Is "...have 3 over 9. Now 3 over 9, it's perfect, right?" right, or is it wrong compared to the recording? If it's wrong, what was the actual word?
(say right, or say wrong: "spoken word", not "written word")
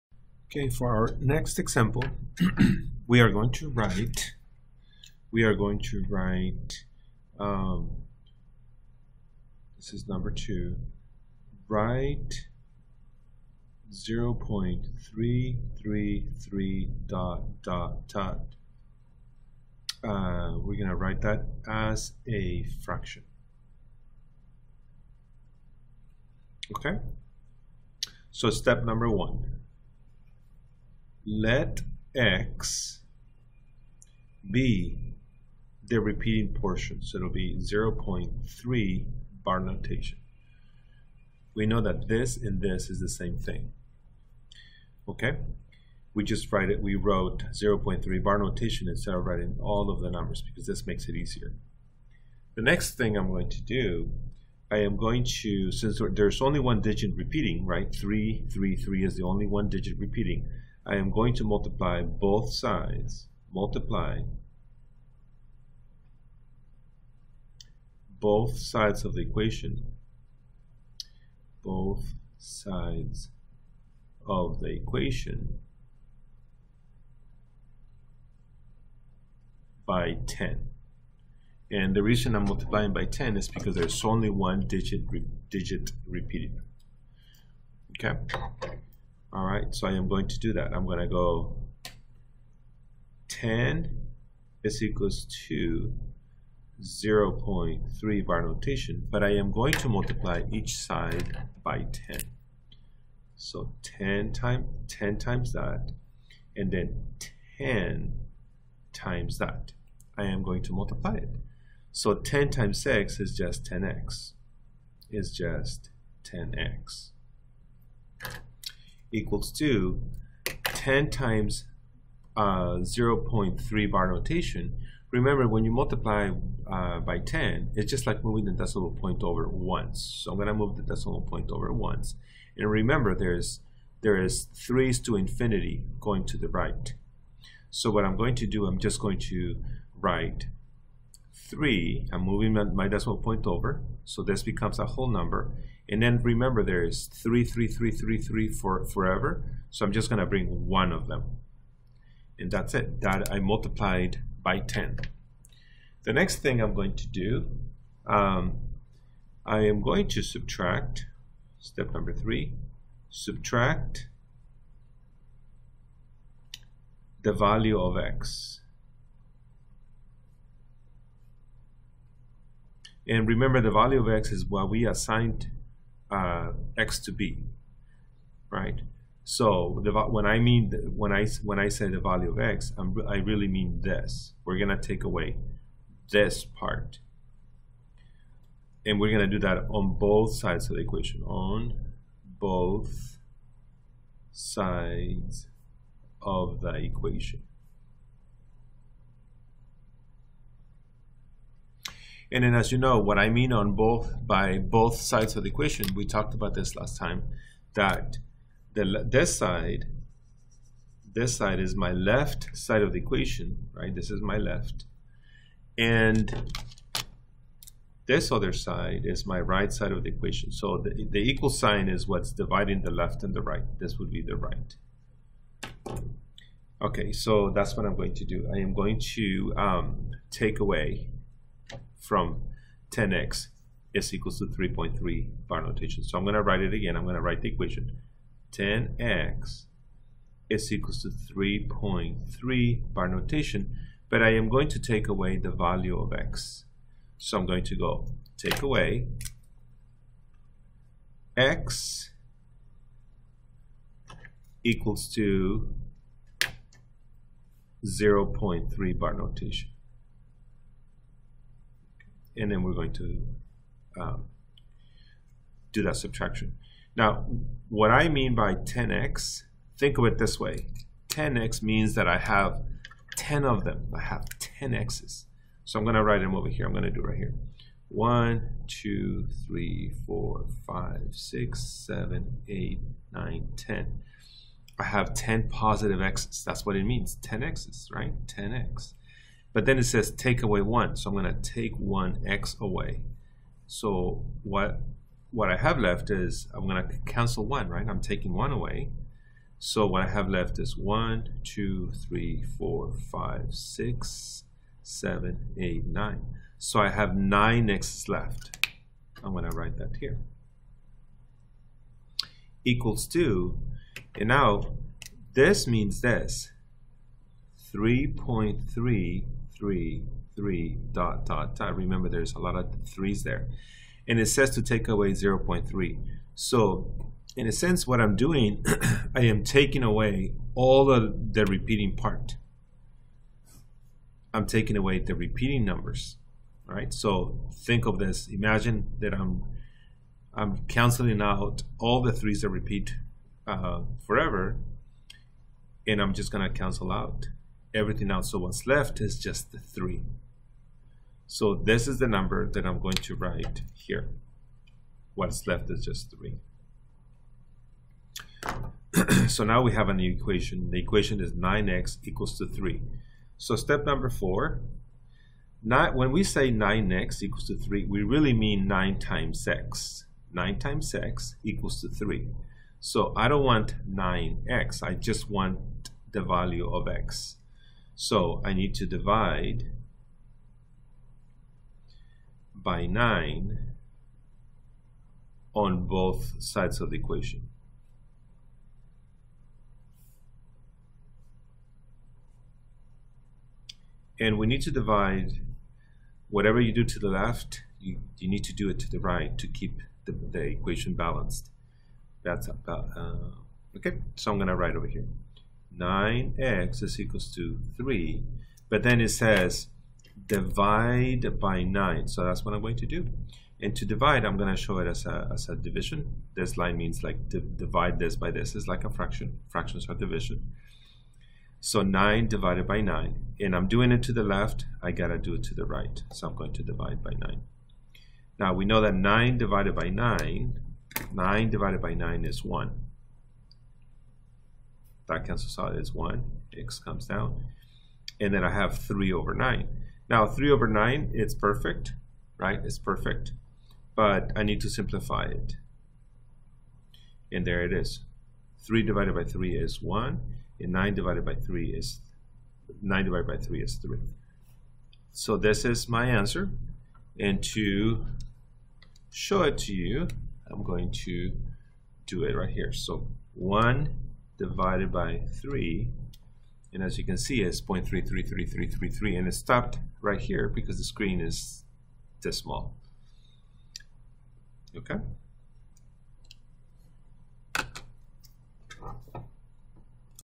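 right.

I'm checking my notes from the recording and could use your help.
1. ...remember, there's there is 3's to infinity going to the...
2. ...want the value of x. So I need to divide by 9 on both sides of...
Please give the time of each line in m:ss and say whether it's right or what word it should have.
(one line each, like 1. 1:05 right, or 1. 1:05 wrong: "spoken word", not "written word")
1. 2:12 right
2. 6:15 right.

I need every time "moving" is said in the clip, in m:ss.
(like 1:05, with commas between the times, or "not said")
2:08, 2:22.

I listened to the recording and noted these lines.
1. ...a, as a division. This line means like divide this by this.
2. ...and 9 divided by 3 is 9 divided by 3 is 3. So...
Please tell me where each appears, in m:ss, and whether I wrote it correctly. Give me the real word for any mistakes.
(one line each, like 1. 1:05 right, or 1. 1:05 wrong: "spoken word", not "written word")
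1. 6:55 right
2. 7:30 right.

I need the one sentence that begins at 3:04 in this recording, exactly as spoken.
We're gonna take away this part, and we're gonna do that on both sides of the equation.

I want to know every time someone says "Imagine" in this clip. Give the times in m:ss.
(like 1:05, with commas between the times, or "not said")
5:38.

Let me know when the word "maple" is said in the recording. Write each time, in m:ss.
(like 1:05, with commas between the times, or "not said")
not said.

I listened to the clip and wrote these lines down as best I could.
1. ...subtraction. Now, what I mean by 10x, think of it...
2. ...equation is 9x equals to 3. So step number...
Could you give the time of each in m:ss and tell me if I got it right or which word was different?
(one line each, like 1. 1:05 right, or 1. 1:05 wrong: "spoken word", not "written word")
1. 4:25 right
2. 6:00 right.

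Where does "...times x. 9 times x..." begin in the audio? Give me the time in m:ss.
6:08.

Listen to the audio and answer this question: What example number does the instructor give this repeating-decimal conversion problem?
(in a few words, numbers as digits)
2.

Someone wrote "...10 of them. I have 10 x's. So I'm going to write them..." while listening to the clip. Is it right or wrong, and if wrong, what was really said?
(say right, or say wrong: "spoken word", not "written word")
right.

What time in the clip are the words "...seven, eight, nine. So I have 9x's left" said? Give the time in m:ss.
5:04.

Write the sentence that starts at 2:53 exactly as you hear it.
And remember the value of x is what we assigned uh, x to b, right?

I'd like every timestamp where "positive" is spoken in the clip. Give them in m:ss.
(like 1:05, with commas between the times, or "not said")
4:45.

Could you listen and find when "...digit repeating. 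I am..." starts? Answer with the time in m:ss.
0:59.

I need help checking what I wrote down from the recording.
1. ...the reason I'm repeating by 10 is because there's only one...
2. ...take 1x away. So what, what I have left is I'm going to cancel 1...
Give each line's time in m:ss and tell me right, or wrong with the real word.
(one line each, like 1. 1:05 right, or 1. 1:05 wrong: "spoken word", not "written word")
1. 1:21 wrong: "multiplying", not "repeating"
2. 4:51 right.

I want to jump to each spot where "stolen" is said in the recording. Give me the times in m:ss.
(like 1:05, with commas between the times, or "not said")
not said.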